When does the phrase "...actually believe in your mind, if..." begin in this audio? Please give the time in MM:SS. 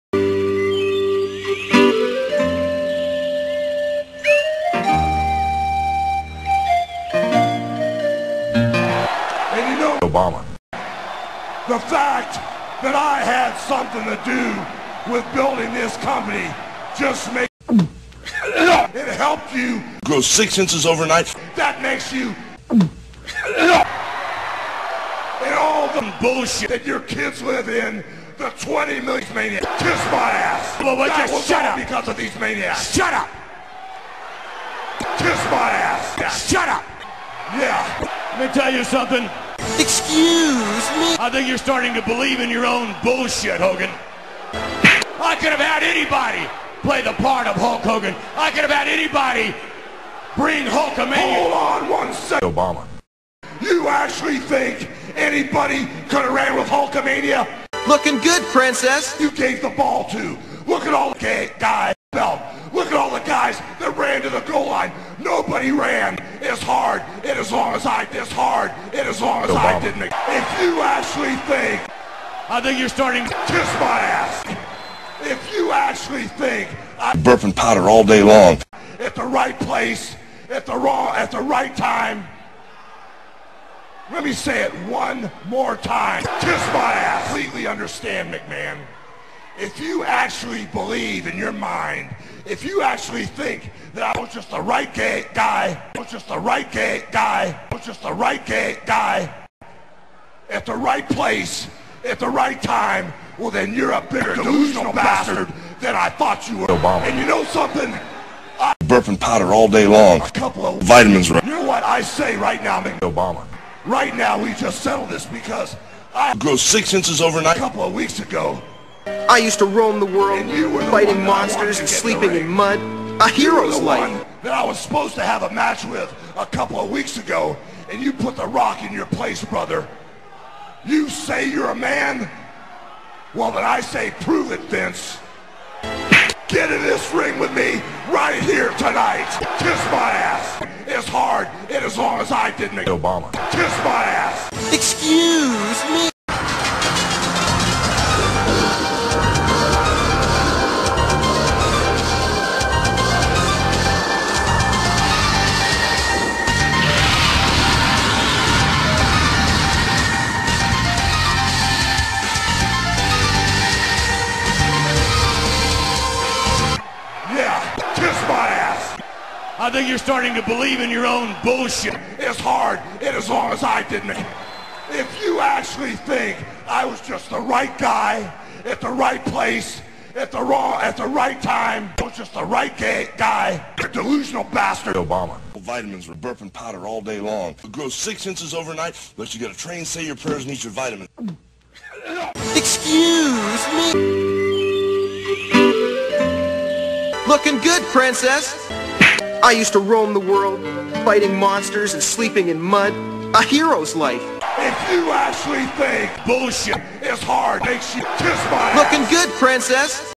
01:30.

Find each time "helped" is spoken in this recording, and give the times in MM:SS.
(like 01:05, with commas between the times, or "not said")
00:19.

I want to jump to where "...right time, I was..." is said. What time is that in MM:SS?
03:01.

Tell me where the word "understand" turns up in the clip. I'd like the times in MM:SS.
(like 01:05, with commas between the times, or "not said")
01:27.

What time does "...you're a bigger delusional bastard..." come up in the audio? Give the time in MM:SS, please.
01:43.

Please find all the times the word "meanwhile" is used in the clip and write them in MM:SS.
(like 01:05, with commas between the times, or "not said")
not said.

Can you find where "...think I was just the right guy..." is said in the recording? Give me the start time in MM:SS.
02:55.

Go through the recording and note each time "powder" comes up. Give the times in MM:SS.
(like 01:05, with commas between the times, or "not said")
01:17, 01:49, 03:06.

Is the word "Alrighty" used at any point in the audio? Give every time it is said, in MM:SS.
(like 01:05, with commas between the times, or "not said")
not said.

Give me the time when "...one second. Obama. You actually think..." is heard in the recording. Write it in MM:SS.
00:51.